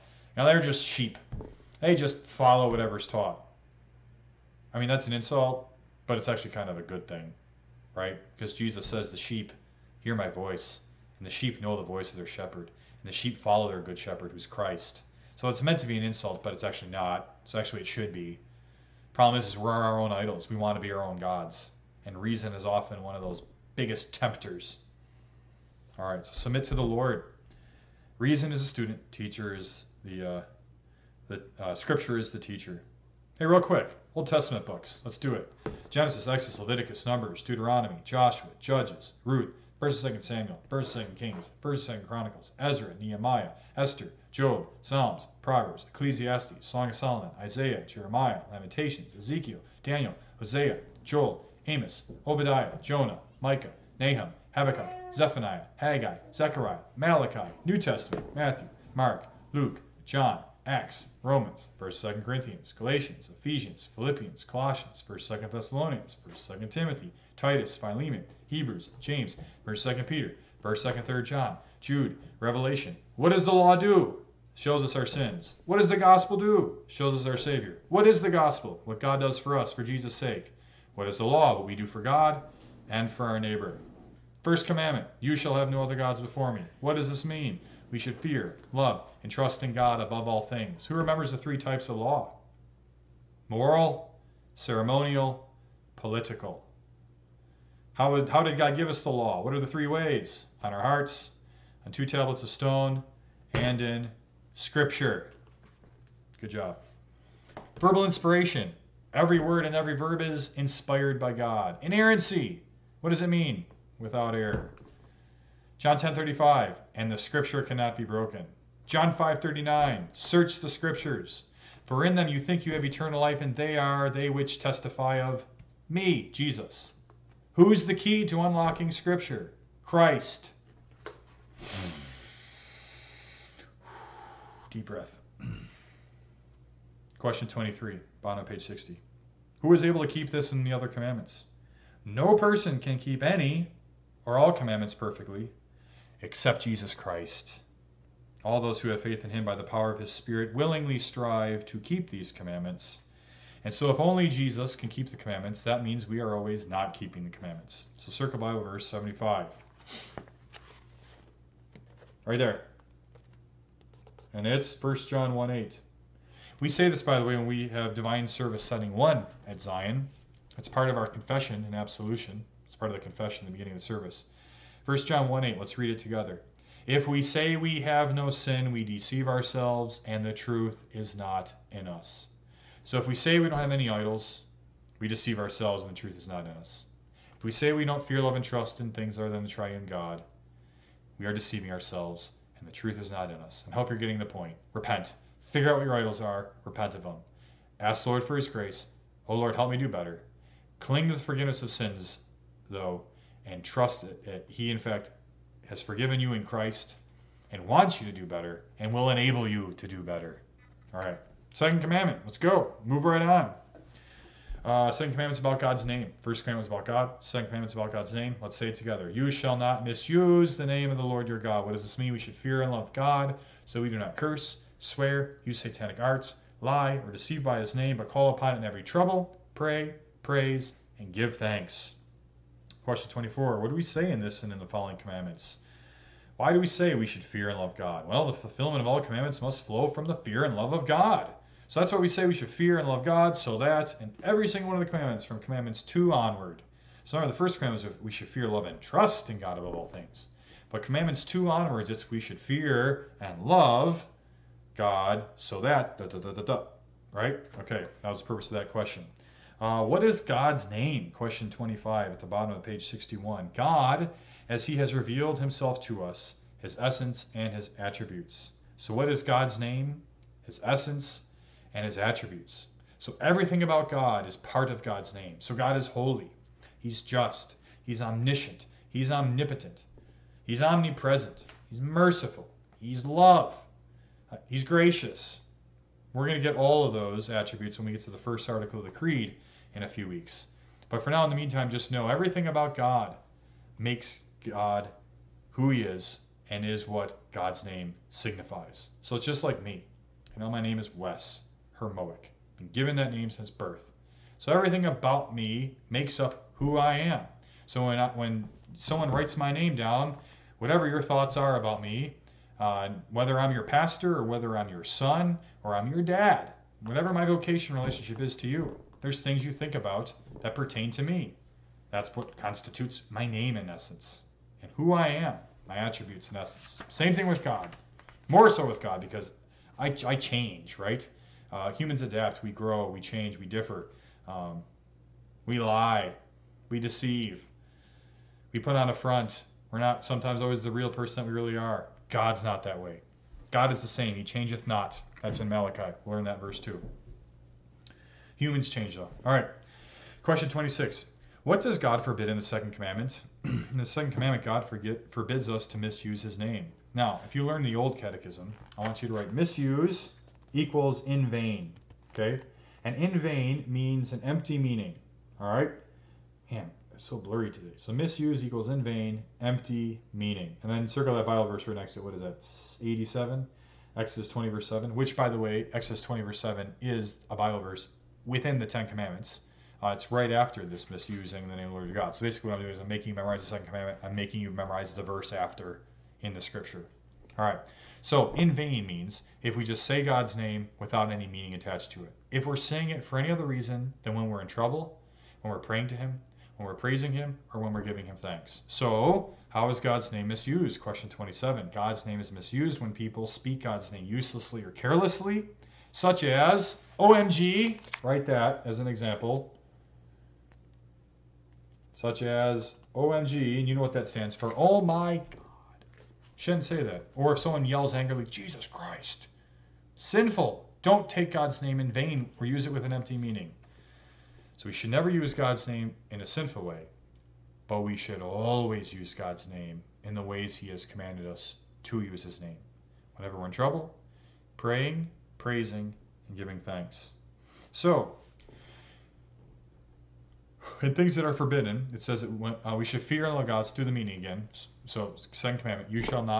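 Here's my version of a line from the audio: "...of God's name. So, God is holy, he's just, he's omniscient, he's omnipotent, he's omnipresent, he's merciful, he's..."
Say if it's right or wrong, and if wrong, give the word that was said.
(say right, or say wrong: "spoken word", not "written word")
right.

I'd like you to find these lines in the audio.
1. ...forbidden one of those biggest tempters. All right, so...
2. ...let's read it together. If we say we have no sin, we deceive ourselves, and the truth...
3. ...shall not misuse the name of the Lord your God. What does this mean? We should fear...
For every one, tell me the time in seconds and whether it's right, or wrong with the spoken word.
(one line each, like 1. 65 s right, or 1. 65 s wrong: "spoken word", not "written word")
1. 22 s wrong: "often", not "forbidden"
2. 175 s right
3. 219 s right.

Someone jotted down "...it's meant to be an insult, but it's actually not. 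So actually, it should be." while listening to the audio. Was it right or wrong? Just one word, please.
right.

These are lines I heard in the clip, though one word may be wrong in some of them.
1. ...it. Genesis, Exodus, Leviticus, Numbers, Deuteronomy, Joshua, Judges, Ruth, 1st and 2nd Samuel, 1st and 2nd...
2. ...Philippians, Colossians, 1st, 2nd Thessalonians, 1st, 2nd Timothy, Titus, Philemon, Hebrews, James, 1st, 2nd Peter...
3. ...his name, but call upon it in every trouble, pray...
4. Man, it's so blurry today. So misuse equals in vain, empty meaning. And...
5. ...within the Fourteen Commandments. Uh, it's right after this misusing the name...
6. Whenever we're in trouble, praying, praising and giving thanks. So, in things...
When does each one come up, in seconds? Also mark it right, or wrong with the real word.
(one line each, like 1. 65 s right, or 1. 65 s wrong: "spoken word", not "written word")
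1. 35 s right
2. 63 s right
3. 227 s right
4. 366 s right
5. 378 s wrong: "Ten", not "Fourteen"
6. 433 s right.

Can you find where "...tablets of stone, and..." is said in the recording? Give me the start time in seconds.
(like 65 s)
102 s.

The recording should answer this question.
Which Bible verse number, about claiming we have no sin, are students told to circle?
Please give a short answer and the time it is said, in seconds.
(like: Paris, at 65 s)
75, at 158 s.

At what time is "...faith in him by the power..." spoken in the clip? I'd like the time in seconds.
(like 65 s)
149 s.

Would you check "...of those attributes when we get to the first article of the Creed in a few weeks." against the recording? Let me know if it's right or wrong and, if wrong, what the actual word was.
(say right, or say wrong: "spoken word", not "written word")
right.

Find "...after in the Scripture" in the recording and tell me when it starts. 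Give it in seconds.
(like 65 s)
385 s.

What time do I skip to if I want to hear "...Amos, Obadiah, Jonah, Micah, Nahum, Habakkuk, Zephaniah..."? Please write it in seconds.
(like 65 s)
51 s.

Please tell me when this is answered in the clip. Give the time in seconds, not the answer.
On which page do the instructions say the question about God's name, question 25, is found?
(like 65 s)
262 s.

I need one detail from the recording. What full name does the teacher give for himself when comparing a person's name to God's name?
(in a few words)
Wes Hermoic.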